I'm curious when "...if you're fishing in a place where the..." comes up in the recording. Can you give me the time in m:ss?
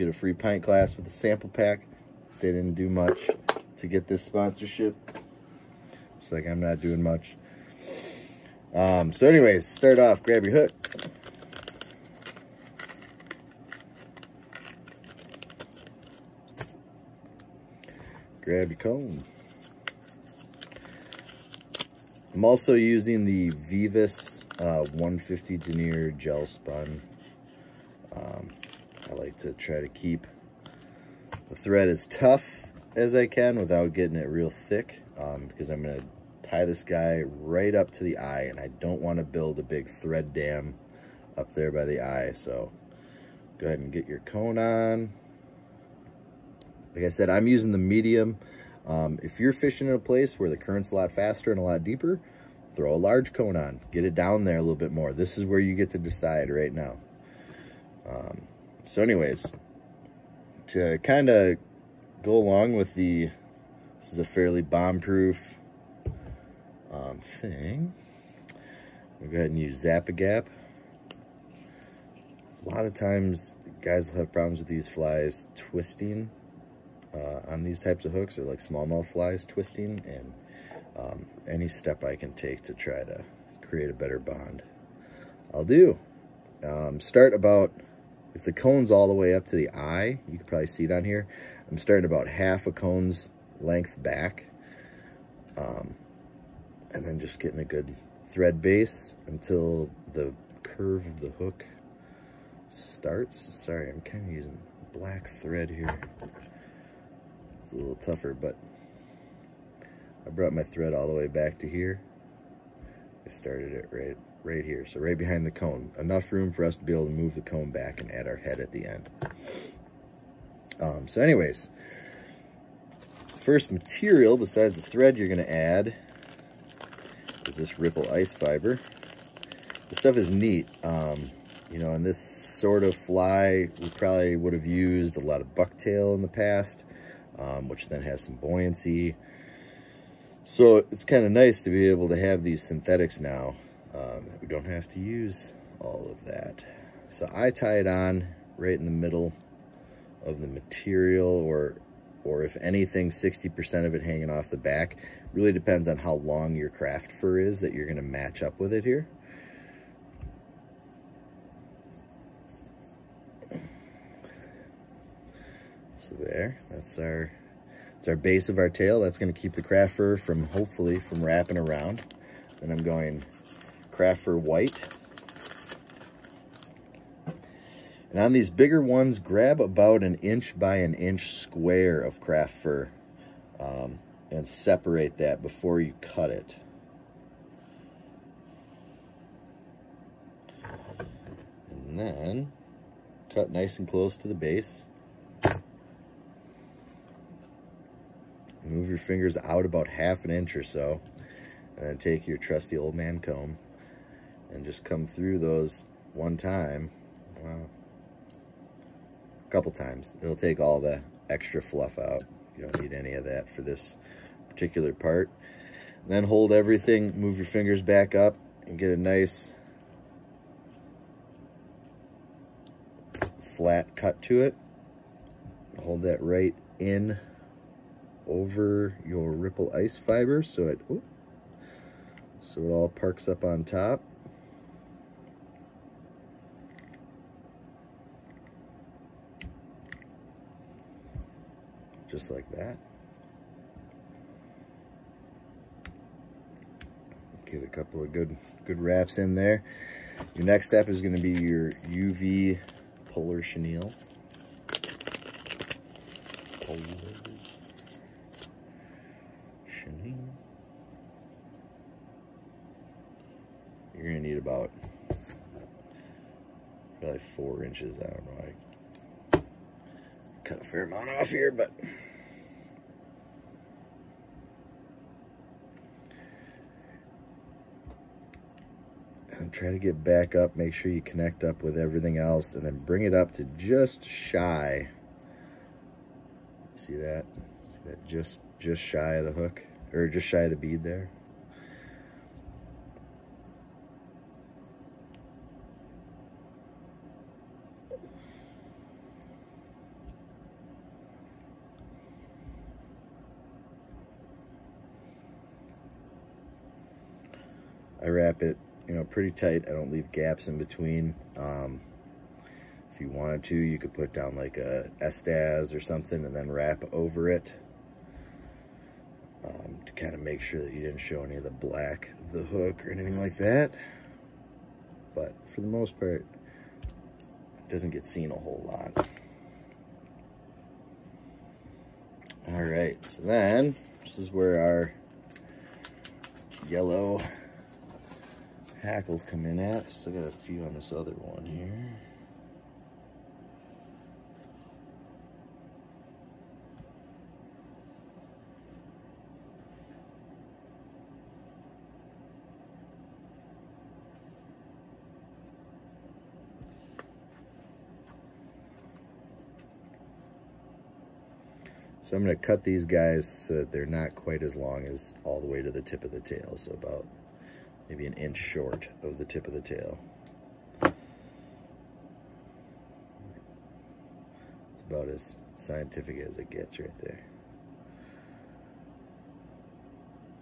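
0:49.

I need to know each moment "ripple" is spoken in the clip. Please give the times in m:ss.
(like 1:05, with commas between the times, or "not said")
2:07, 3:49.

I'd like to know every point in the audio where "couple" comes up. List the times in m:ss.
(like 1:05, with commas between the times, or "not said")
3:29, 4:07.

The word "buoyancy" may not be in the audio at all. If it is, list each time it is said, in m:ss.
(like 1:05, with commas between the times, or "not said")
2:18.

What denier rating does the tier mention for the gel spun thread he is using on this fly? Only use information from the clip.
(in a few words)
150.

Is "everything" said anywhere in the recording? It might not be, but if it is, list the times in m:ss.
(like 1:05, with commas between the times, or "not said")
3:36, 4:41.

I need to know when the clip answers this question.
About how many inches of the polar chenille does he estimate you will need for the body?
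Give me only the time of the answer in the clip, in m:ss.
4:27.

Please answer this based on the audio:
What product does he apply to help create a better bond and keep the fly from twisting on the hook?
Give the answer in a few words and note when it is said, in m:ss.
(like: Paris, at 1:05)
Zappa, at 1:09.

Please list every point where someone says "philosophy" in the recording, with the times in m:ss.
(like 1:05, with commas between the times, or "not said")
not said.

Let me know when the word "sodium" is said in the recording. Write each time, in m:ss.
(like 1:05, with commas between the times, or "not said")
not said.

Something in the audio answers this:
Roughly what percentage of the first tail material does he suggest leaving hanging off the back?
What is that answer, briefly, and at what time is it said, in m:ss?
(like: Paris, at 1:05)
60%, at 2:33.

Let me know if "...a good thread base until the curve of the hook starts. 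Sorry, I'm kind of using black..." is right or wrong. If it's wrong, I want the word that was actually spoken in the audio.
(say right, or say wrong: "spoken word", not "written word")
right.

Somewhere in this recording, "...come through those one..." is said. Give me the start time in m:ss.
3:24.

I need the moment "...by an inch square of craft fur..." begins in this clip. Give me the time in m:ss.
3:00.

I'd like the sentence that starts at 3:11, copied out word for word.
And then cut nice and close to the base.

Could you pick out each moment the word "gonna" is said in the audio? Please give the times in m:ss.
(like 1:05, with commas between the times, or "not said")
4:11, 4:24.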